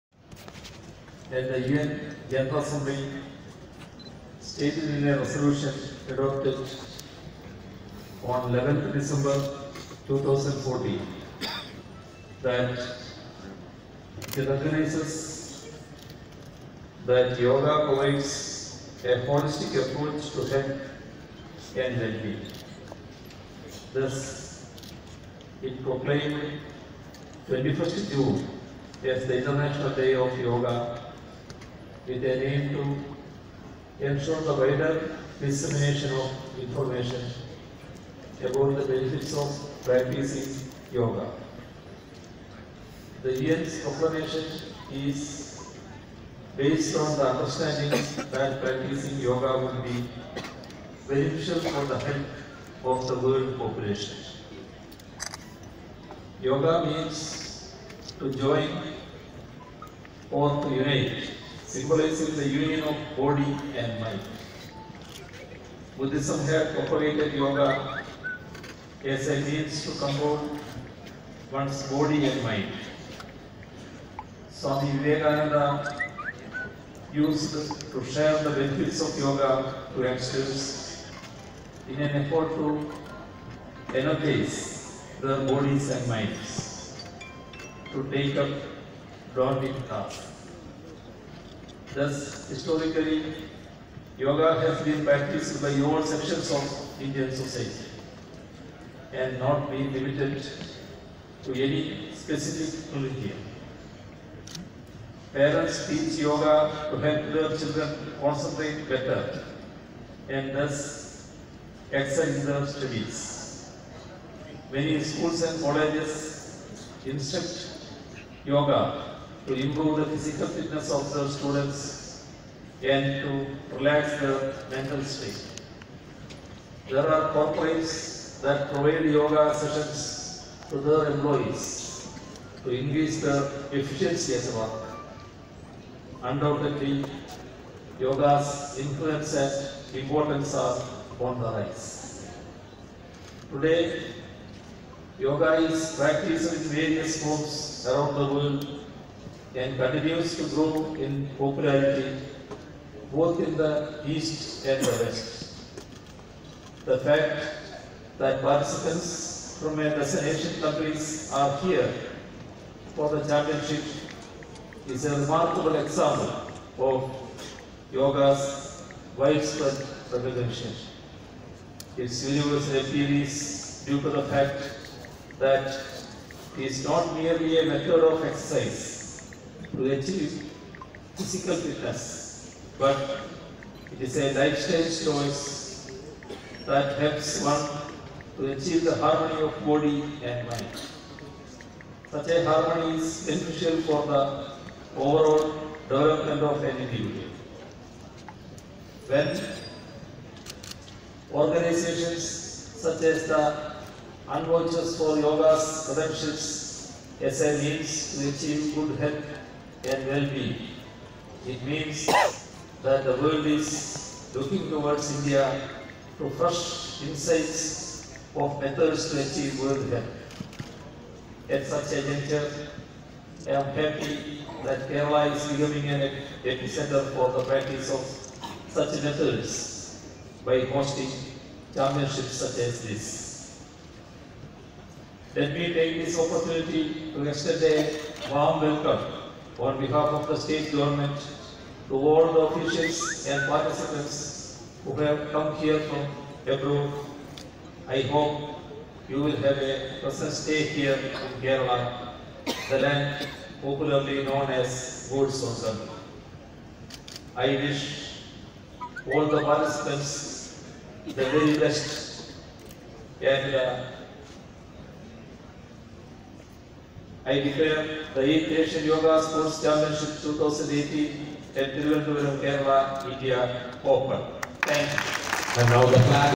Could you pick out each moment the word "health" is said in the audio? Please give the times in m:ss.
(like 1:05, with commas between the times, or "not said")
0:20, 0:51, 3:28, 3:39.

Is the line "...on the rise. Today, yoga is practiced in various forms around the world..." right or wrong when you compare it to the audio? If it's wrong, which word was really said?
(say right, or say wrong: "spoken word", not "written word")
right.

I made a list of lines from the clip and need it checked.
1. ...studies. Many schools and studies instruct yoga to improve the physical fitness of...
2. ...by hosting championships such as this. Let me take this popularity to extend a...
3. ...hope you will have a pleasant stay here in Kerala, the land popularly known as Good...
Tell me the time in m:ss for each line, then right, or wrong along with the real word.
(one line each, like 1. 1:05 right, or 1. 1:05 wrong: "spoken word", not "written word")
1. 1:52 wrong: "colleges", not "studies"
2. 3:50 wrong: "opportunity", not "popularity"
3. 4:08 right.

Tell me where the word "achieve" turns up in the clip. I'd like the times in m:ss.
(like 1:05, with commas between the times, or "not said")
2:59, 3:08, 3:28, 3:39.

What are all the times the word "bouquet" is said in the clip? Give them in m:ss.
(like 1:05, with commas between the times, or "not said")
not said.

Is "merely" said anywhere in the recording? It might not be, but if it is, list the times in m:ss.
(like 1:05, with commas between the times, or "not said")
2:57.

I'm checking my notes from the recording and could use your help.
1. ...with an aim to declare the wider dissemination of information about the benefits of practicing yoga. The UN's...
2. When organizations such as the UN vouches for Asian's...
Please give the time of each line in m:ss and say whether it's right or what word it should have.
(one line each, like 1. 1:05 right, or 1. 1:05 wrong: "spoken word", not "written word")
1. 0:32 wrong: "ensure", not "declare"
2. 3:19 wrong: "Yoga", not "Asian".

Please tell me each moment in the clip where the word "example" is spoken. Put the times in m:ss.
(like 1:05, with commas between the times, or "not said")
2:45.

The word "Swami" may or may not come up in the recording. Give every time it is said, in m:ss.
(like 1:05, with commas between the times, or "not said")
1:14.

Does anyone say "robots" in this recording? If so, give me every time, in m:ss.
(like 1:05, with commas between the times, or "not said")
not said.